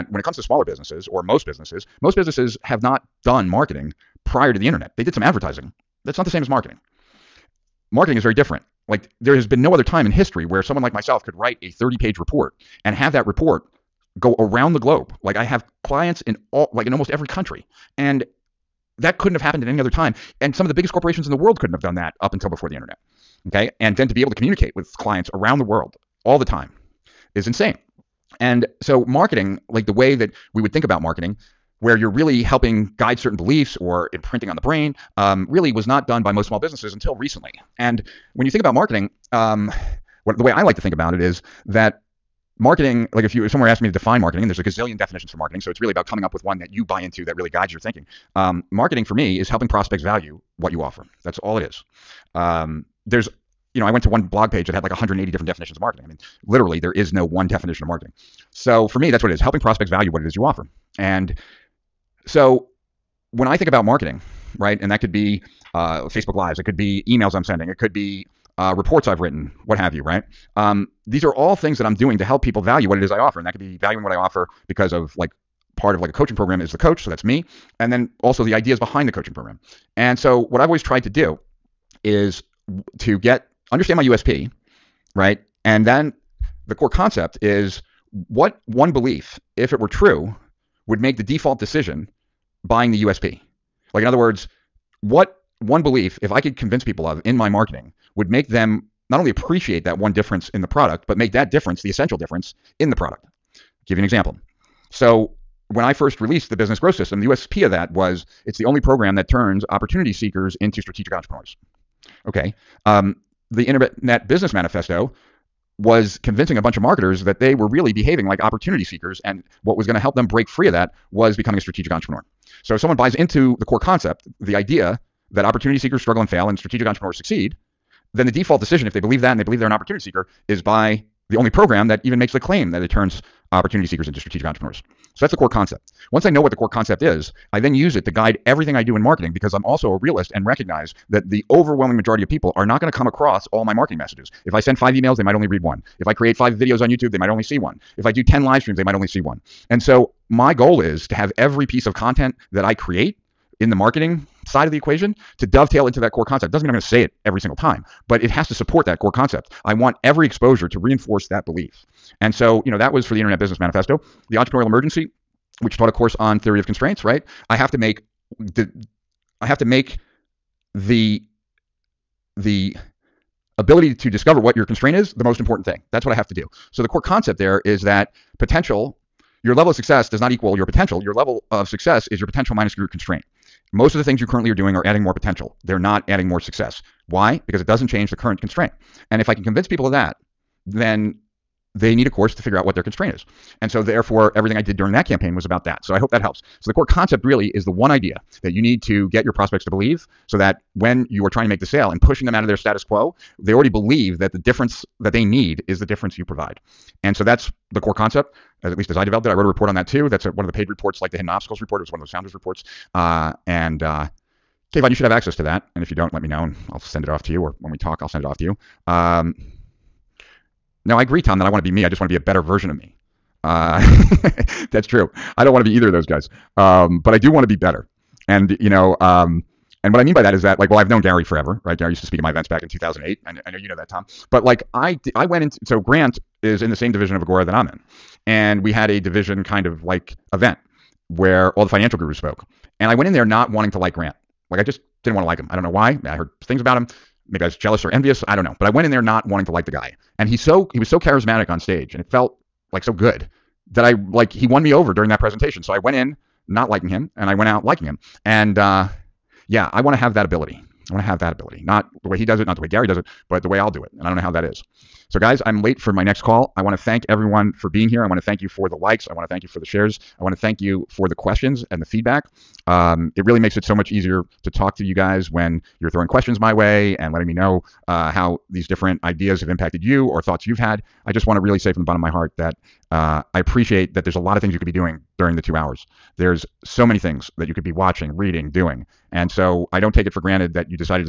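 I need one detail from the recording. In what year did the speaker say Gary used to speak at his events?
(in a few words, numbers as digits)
2008.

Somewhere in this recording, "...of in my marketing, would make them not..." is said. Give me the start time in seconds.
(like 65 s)
97 s.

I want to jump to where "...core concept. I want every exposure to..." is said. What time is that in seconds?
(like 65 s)
158 s.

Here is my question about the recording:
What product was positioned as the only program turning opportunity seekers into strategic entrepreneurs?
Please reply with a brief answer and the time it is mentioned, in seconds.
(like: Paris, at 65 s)
business growth system, at 106 s.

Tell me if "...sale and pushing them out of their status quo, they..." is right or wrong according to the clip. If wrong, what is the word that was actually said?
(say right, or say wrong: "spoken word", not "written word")
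right.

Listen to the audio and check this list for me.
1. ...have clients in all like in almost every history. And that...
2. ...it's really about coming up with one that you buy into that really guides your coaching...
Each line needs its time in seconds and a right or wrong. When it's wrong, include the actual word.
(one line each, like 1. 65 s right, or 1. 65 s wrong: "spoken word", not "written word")
1. 15 s wrong: "country", not "history"
2. 45 s wrong: "thinking", not "coaching".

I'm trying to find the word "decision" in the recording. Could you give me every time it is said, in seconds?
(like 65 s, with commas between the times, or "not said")
91 s, 128 s.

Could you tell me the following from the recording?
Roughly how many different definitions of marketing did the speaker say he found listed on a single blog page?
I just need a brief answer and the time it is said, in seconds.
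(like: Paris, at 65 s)
180, at 54 s.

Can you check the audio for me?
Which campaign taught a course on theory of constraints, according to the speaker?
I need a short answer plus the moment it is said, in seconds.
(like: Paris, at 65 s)
The Entrepreneurial Emergency, at 164 s.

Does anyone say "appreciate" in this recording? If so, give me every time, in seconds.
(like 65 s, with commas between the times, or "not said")
99 s, 283 s.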